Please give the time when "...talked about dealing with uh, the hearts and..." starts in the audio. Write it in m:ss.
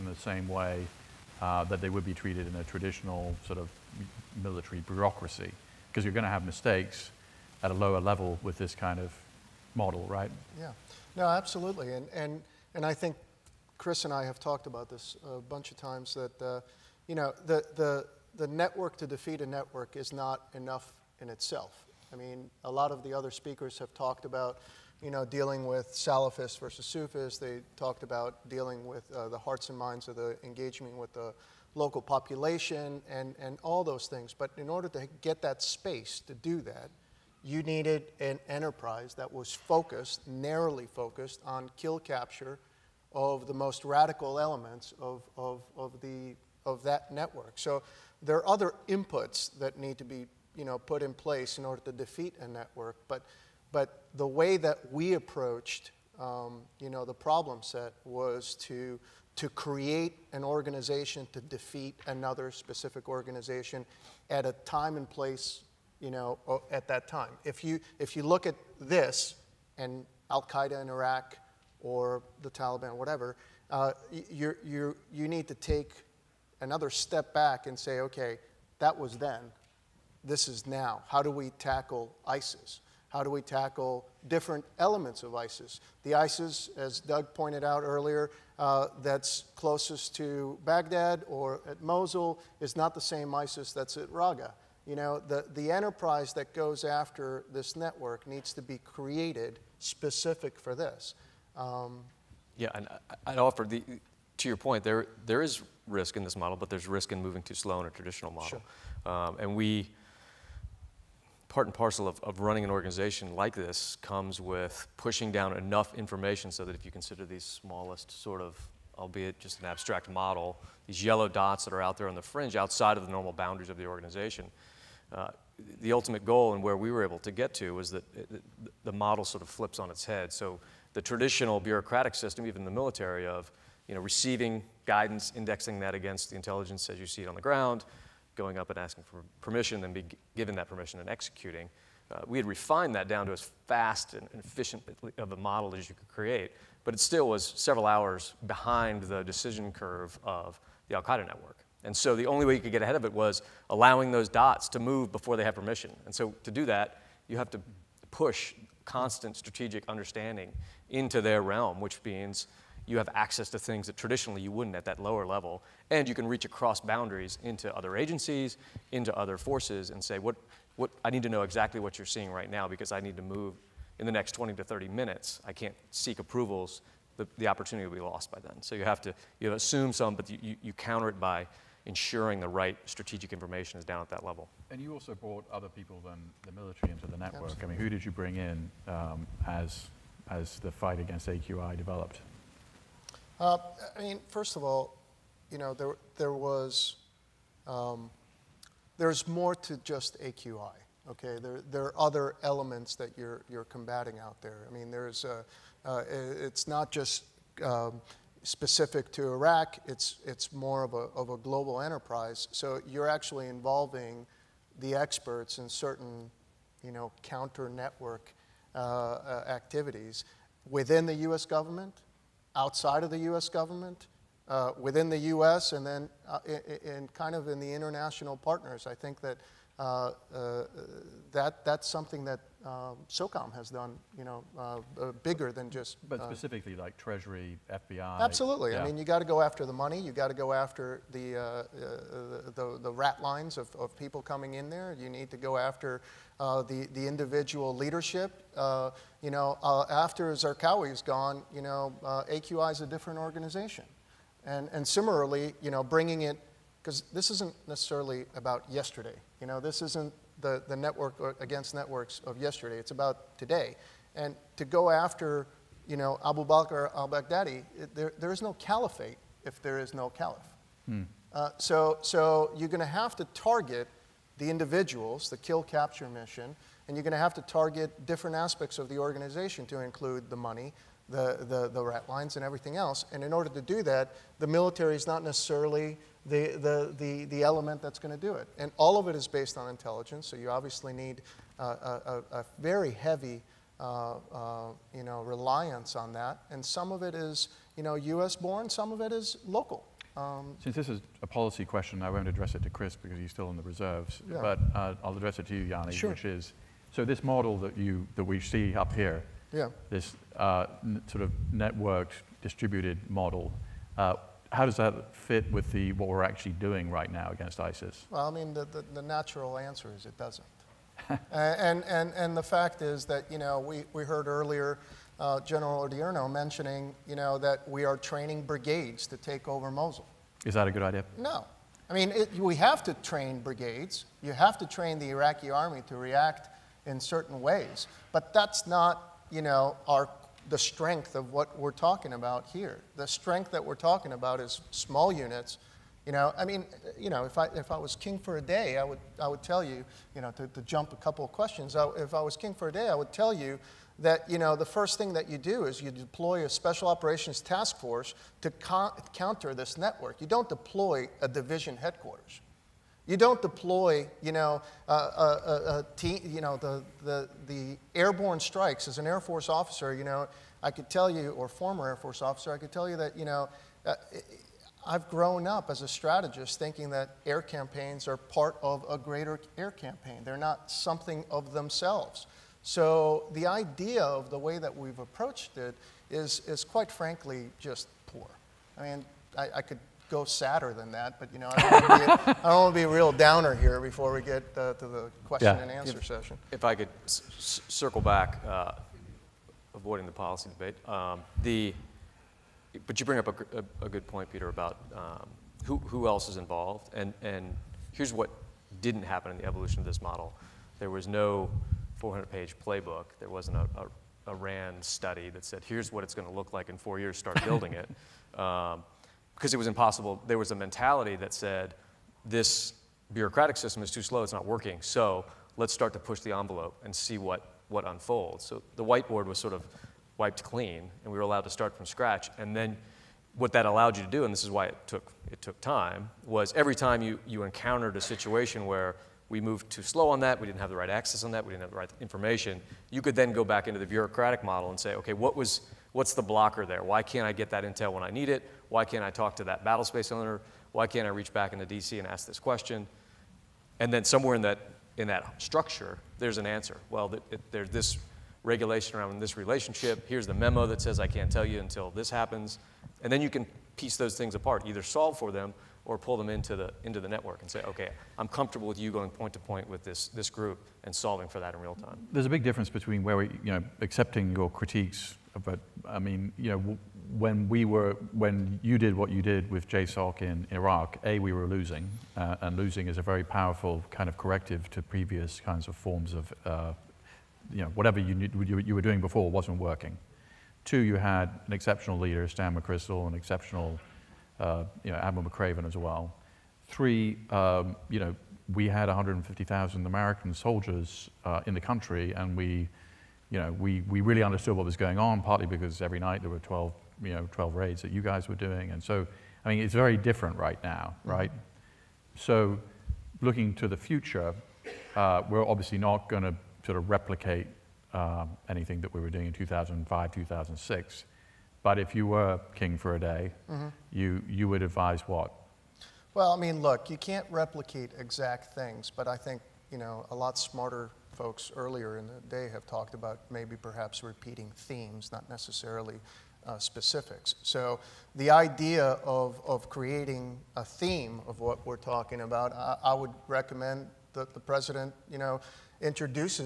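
0:27.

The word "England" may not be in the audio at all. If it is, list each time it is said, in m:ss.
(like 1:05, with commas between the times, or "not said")
not said.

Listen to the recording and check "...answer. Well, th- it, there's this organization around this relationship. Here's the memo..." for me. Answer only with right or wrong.
wrong.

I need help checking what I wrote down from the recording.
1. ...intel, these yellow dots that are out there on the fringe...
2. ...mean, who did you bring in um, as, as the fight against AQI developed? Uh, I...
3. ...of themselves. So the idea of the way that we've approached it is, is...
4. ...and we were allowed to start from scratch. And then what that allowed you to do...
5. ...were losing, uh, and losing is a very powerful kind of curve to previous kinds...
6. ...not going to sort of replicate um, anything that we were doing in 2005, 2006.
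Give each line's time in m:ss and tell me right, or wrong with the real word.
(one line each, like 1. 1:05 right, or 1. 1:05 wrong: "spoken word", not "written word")
1. 2:00 wrong: "model", not "intel"
2. 3:07 right
3. 6:21 right
4. 7:11 right
5. 8:01 wrong: "corrective", not "curve"
6. 8:35 right.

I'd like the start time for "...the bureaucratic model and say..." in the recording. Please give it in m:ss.
7:23.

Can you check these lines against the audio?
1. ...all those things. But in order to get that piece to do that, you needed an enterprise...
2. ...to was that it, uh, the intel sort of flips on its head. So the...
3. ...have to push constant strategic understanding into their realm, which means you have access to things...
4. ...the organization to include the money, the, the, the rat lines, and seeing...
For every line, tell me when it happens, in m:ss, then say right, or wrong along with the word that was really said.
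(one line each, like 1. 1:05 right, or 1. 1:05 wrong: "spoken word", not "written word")
1. 0:33 wrong: "space", not "piece"
2. 2:07 wrong: "model", not "intel"
3. 2:37 right
4. 4:38 wrong: "everything", not "seeing".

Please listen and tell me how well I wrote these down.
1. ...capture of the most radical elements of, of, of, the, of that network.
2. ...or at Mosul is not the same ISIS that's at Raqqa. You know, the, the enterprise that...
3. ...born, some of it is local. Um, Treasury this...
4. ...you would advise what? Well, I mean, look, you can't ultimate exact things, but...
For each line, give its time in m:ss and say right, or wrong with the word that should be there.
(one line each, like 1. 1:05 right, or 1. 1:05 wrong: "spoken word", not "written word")
1. 0:41 right
2. 1:31 right
3. 4:58 wrong: "Since", not "Treasury"
4. 8:44 wrong: "replicate", not "ultimate".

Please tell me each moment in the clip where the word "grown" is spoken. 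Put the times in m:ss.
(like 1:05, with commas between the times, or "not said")
6:15.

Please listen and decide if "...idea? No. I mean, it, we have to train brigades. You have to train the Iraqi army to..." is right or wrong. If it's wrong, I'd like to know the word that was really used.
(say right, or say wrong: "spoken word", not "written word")
right.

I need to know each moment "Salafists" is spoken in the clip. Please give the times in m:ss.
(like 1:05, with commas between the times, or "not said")
0:25.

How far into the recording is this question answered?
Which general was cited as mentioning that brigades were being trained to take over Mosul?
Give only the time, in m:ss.
5:25.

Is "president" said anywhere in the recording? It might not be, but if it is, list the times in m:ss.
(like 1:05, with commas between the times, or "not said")
9:04.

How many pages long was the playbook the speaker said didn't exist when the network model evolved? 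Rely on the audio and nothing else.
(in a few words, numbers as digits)
400.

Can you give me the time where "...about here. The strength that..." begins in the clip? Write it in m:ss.
5:42.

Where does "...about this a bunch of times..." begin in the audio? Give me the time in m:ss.
0:14.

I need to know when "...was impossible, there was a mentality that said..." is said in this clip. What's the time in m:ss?
6:59.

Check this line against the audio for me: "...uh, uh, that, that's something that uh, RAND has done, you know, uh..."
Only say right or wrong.
wrong.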